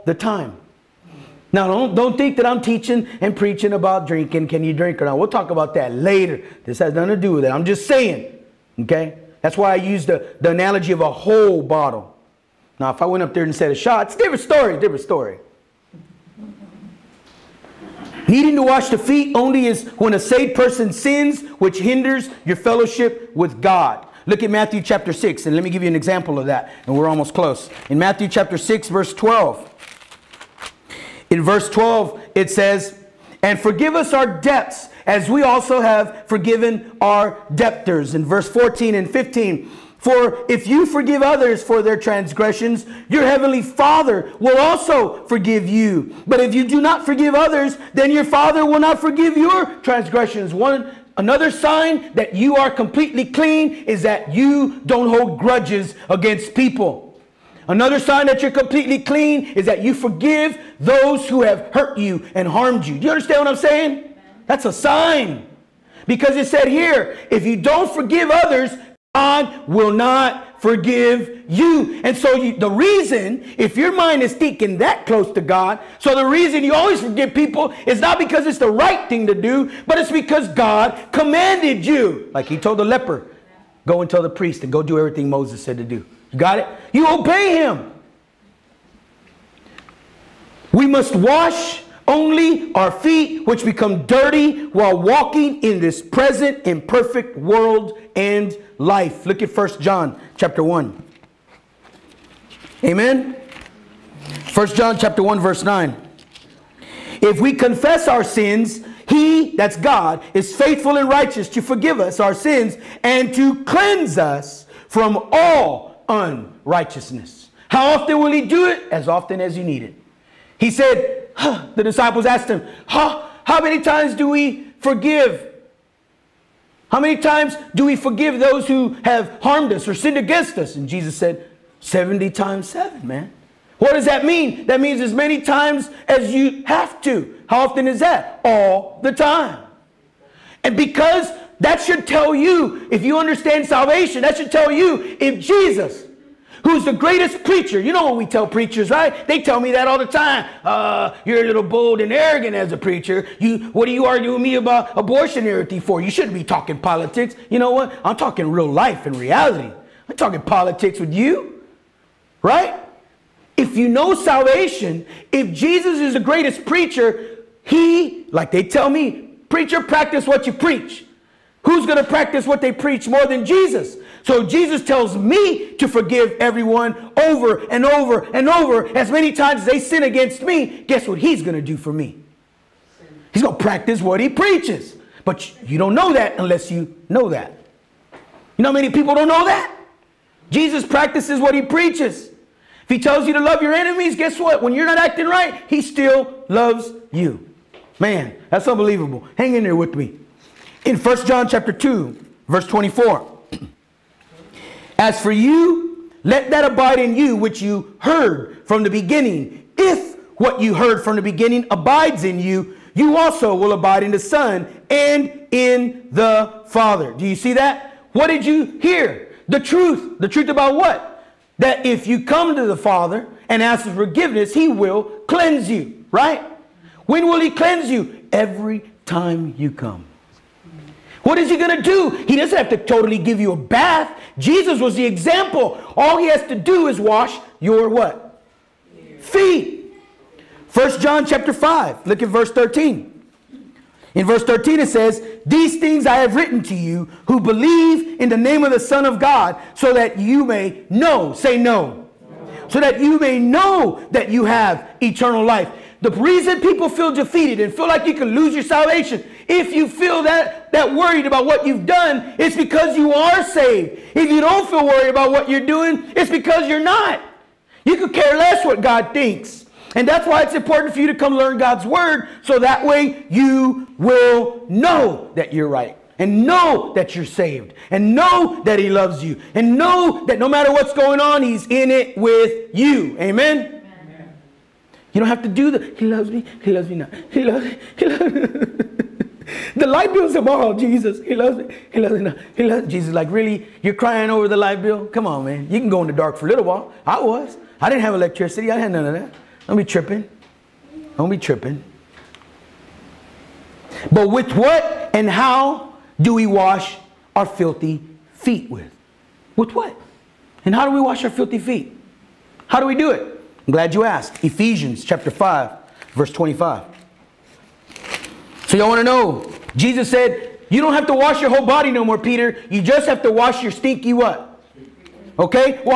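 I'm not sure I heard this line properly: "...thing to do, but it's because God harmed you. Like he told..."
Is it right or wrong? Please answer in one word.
wrong.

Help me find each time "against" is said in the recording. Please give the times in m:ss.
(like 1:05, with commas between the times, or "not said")
0:56, 2:10, 3:00.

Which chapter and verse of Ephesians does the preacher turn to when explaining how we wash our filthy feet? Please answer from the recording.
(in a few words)
Ephesians 5:25.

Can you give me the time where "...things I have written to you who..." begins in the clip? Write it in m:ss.
4:05.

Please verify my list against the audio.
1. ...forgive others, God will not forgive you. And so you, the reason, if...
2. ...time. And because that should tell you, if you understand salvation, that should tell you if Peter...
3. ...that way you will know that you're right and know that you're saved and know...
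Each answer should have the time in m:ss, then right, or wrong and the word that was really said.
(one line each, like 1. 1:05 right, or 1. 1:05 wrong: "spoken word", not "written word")
1. 1:07 right
2. 2:19 wrong: "Jesus", not "Peter"
3. 4:32 right.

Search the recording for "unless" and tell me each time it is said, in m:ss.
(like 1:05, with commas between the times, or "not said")
3:06.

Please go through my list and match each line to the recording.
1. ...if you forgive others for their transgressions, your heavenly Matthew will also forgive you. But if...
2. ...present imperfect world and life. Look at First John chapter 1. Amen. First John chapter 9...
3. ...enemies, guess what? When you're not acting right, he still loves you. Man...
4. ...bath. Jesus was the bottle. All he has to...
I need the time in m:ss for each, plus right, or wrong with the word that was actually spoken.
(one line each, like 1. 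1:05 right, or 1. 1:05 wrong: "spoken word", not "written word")
1. 0:40 wrong: "Father", not "Matthew"
2. 1:36 wrong: "1", not "9"
3. 3:13 right
4. 3:53 wrong: "example", not "bottle".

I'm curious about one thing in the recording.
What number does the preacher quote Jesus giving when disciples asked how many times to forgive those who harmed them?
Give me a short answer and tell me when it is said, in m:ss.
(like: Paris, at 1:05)
70 times 7, at 2:11.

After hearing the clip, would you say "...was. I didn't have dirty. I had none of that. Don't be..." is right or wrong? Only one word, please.
wrong.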